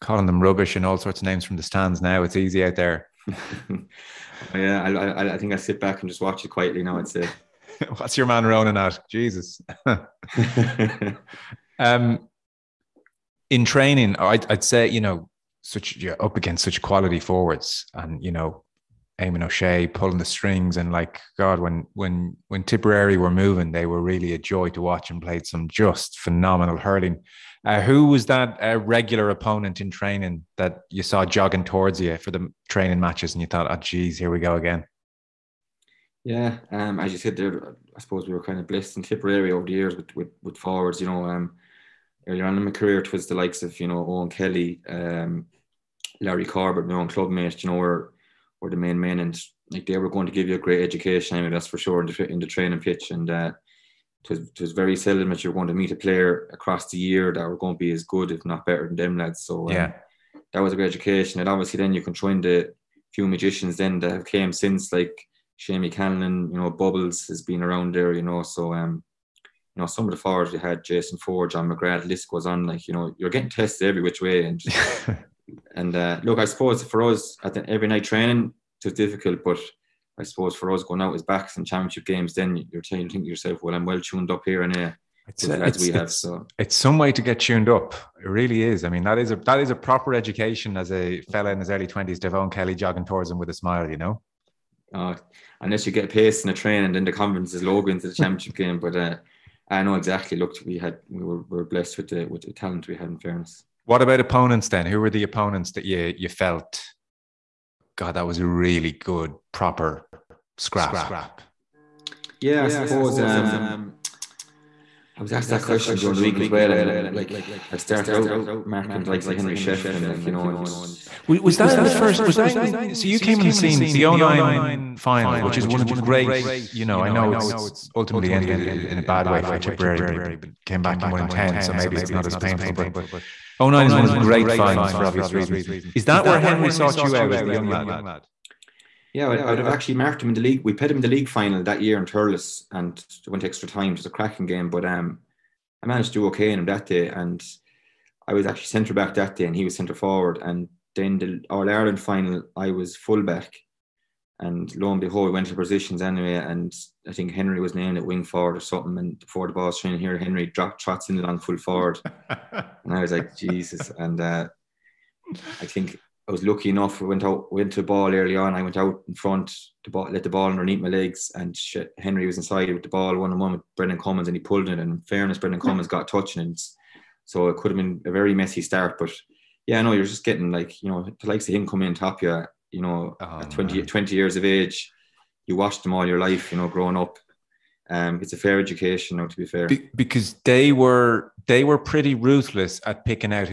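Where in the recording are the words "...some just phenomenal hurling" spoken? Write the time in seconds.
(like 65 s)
25 s.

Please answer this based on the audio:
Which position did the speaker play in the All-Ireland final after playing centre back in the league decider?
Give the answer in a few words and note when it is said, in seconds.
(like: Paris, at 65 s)
Full back, at 152 s.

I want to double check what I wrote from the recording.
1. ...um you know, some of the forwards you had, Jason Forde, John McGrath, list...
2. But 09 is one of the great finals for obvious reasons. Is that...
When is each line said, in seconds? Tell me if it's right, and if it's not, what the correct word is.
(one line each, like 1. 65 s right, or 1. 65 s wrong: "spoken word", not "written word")
1. 68 s right
2. 132 s right.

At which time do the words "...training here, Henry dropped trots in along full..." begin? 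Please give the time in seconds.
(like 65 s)
159 s.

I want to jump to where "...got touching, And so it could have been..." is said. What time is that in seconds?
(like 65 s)
175 s.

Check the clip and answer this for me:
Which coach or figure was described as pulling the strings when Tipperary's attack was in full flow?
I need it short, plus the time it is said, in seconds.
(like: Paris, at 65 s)
Eamon O'Shea, at 19 s.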